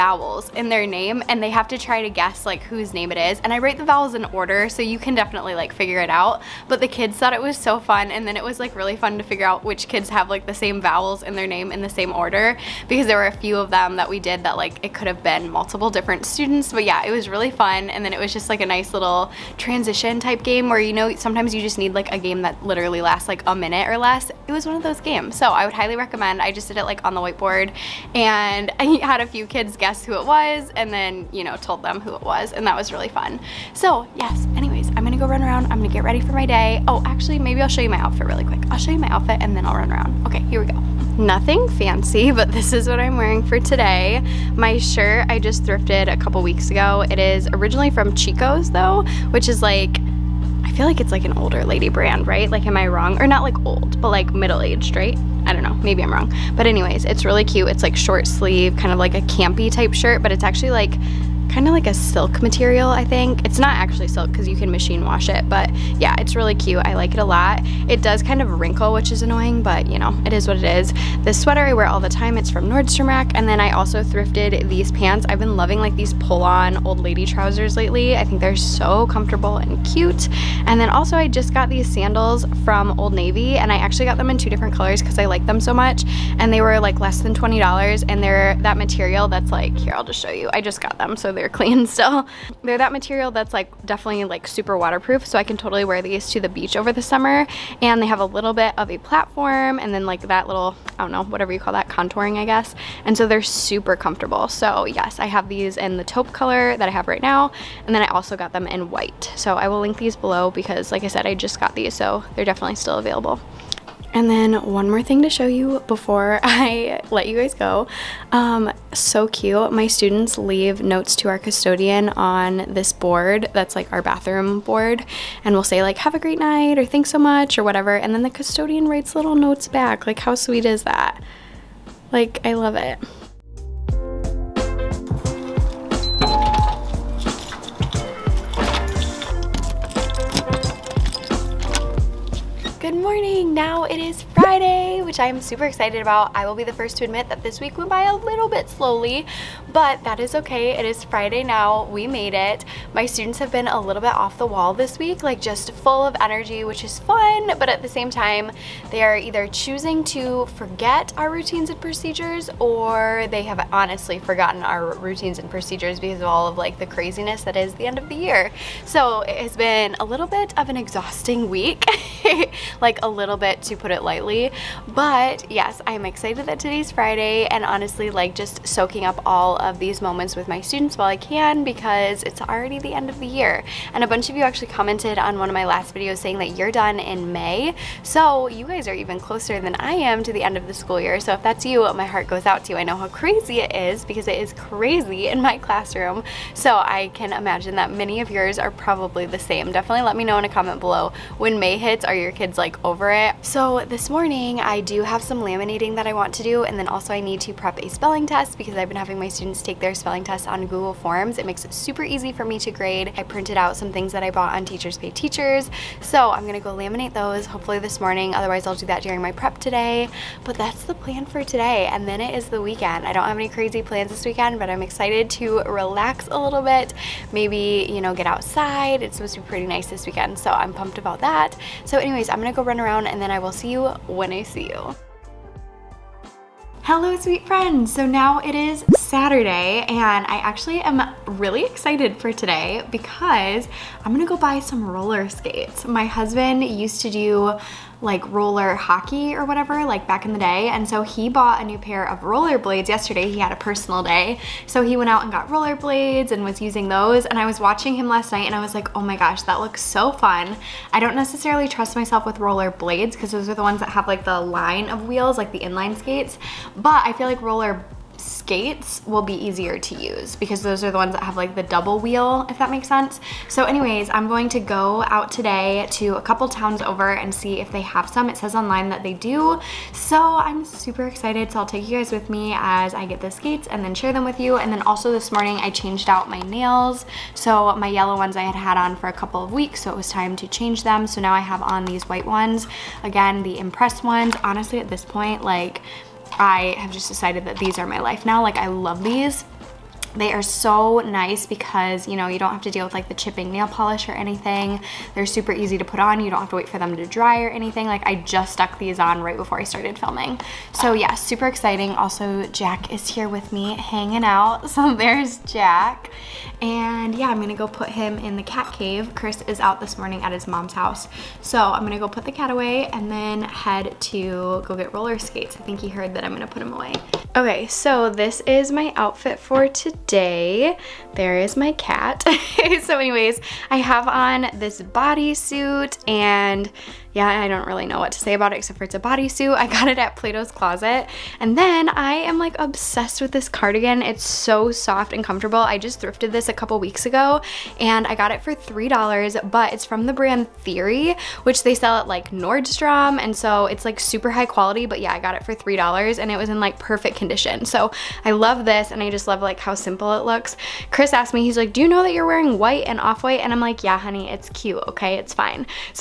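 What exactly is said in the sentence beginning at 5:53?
And so it's like super high quality, but yeah, I got it for $3 and it was in like perfect condition condition.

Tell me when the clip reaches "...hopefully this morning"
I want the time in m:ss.
3:37.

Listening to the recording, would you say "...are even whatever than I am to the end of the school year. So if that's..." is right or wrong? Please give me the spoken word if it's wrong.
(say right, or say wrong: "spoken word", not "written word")
wrong: "closer", not "whatever".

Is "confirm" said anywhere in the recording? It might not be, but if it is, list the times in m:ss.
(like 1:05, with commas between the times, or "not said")
not said.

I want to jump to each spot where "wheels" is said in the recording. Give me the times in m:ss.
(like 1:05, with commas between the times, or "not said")
4:25, 4:32.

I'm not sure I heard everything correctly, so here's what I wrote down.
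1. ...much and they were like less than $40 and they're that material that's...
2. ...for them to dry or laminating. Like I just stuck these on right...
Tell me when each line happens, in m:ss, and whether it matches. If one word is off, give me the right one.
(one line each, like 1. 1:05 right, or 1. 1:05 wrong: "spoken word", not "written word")
1. 1:25 wrong: "20", not "40"
2. 5:06 wrong: "anything", not "laminating".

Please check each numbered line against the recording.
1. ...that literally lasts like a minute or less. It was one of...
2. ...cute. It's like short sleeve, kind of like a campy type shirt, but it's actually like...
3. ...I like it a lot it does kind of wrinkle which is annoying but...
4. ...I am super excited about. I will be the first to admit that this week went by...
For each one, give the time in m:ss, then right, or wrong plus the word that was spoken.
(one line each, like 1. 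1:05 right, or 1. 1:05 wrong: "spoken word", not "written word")
1. 0:22 right
2. 0:57 right
3. 1:06 right
4. 2:25 right.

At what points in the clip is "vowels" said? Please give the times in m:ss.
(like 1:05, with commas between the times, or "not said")
0:03, 0:10.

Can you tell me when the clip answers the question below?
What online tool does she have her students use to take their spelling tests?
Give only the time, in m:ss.
3:30.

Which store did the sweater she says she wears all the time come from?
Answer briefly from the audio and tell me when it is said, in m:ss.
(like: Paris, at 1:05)
Nordstrom Rack, at 1:12.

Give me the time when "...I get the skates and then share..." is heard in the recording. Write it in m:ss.
4:42.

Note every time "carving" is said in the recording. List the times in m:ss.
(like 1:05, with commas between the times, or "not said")
not said.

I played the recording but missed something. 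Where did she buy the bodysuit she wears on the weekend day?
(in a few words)
Plato's Closet.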